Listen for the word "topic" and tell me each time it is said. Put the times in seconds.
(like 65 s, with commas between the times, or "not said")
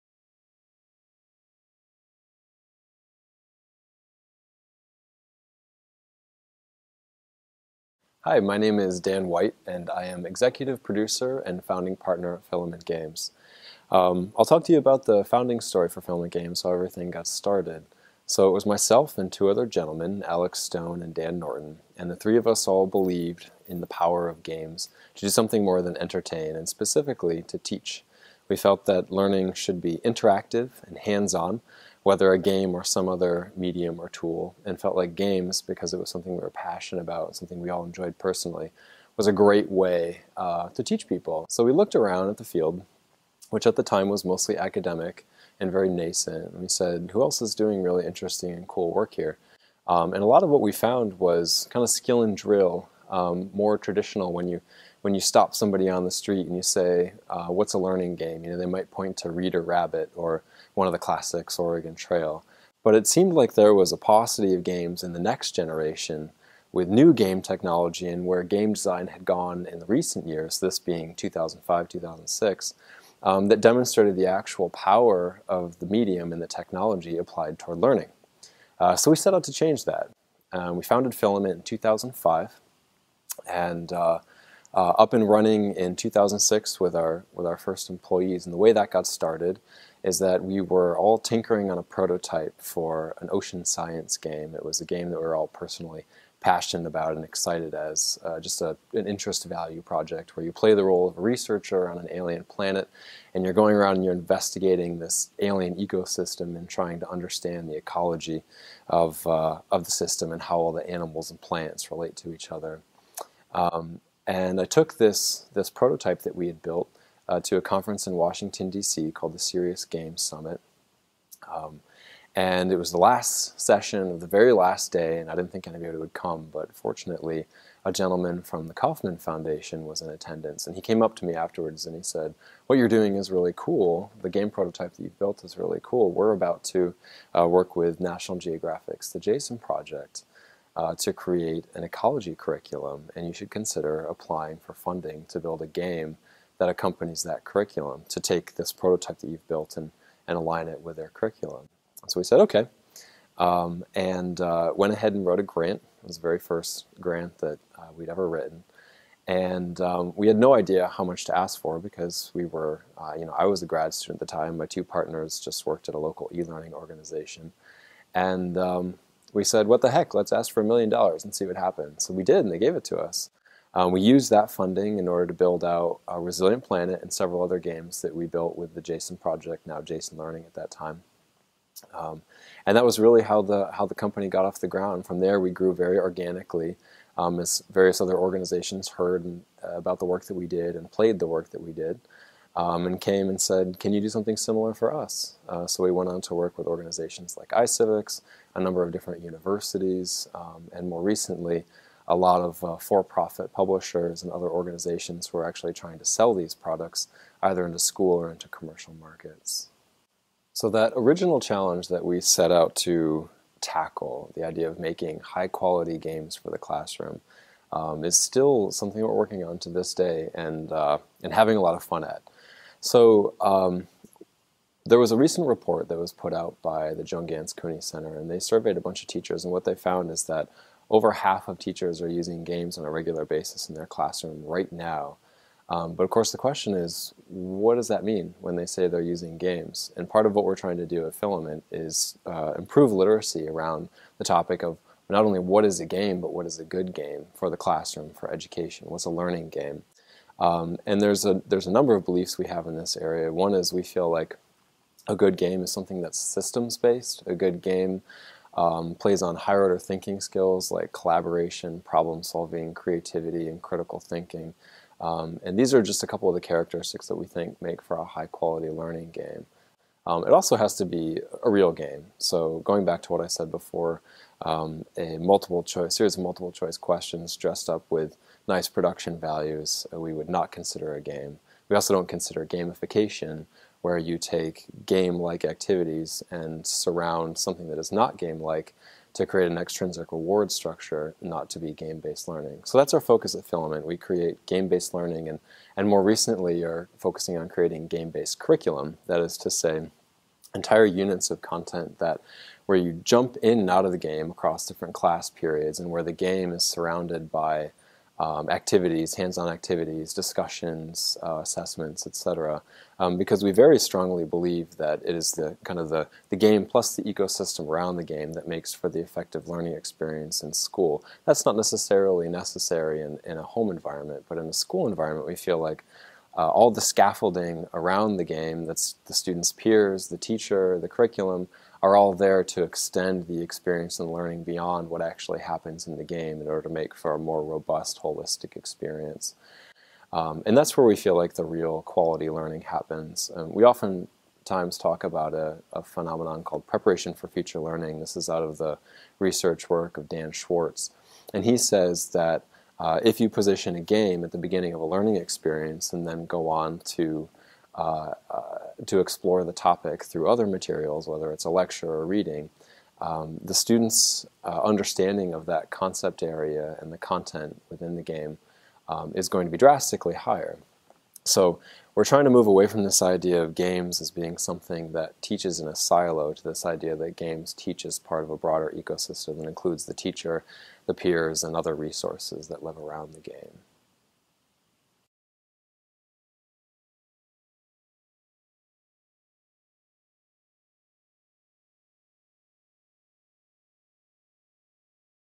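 244 s, 359 s.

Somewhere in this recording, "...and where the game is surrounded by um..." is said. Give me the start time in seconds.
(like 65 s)
305 s.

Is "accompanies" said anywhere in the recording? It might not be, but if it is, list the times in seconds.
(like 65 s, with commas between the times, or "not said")
146 s.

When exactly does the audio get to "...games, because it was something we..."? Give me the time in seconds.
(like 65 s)
35 s.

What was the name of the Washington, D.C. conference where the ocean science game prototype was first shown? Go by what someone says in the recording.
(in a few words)
Serious Games Summit.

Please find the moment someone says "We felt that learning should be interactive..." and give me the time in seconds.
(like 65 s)
28 s.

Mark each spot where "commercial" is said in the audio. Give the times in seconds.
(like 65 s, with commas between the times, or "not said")
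208 s.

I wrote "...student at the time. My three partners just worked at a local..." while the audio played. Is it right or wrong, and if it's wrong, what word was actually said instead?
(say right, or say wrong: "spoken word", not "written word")
wrong: "two", not "three".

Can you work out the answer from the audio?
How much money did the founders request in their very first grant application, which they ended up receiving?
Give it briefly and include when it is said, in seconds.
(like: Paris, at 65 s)
$1 million, at 170 s.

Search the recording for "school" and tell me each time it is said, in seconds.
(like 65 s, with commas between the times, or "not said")
207 s, 320 s, 324 s.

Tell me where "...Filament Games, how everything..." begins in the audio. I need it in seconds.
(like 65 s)
16 s.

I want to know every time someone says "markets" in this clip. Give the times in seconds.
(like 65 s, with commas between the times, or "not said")
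208 s.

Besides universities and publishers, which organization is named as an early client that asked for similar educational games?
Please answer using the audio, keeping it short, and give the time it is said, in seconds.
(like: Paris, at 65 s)
iCivics, at 197 s.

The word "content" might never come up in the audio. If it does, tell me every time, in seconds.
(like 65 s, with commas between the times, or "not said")
301 s, 366 s.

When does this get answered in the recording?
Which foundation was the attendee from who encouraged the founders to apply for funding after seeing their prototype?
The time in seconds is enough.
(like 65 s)
128 s.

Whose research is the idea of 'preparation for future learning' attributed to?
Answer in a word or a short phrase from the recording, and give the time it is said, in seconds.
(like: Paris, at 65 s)
Dan Schwartz, at 350 s.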